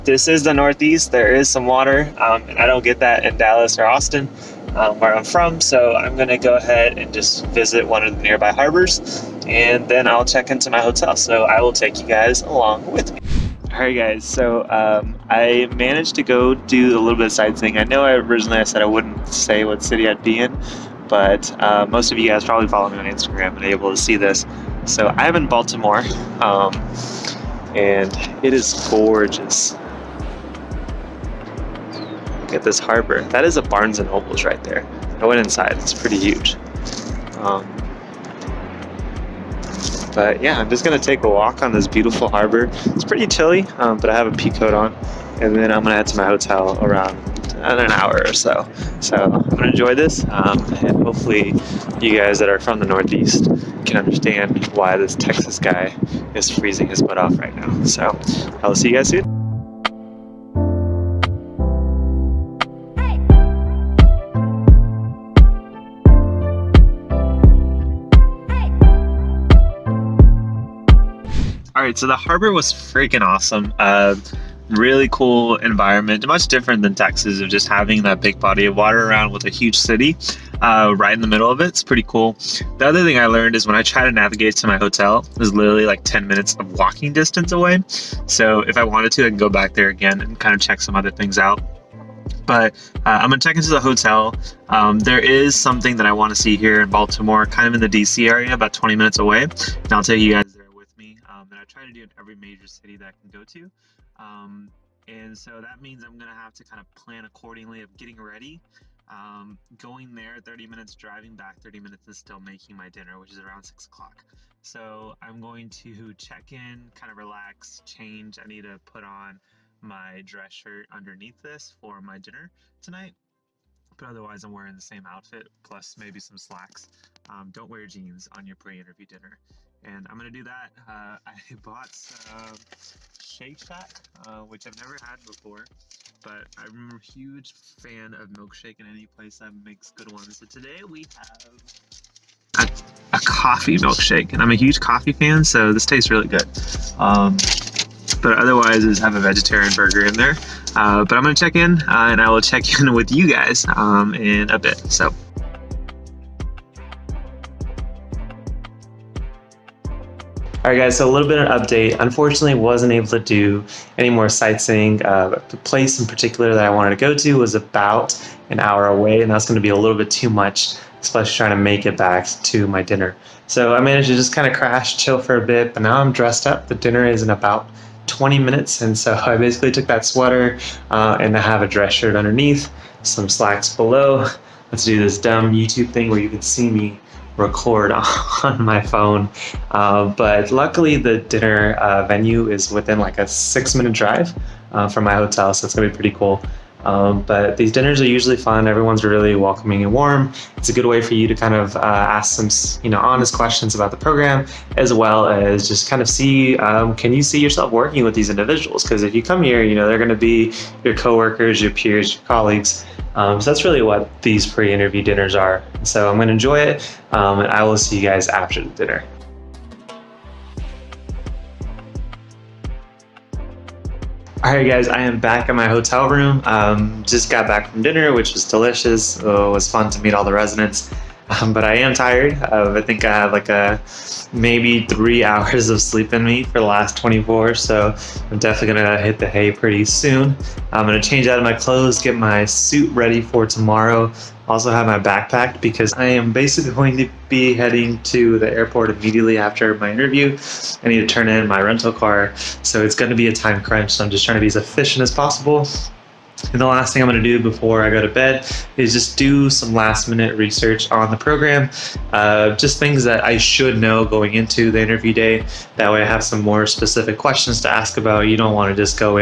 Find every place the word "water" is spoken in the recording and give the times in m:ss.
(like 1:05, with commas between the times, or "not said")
0:01, 1:18.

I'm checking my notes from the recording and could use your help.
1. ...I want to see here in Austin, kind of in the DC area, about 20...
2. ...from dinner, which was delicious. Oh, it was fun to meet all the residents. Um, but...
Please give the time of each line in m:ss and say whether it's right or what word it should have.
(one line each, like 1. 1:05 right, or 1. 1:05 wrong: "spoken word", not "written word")
1. 1:36 wrong: "Baltimore", not "Austin"
2. 3:47 right.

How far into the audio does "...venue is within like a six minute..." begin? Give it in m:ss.
3:12.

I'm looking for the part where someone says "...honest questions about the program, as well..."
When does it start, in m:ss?
3:22.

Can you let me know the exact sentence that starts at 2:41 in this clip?
Unfortunately, wasn't able to do any more sightseeing.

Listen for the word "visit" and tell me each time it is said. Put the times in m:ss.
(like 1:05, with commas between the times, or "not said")
0:07.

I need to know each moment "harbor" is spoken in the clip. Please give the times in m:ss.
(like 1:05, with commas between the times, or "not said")
0:08, 0:32, 0:42, 1:12.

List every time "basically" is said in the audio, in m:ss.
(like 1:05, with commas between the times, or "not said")
2:59, 4:06.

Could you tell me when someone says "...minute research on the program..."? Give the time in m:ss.
4:20.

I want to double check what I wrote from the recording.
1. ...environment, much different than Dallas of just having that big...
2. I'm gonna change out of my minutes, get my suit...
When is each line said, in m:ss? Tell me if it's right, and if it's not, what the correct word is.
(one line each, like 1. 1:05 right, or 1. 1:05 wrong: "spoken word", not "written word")
1. 1:15 wrong: "Texas", not "Dallas"
2. 4:00 wrong: "clothes", not "minutes".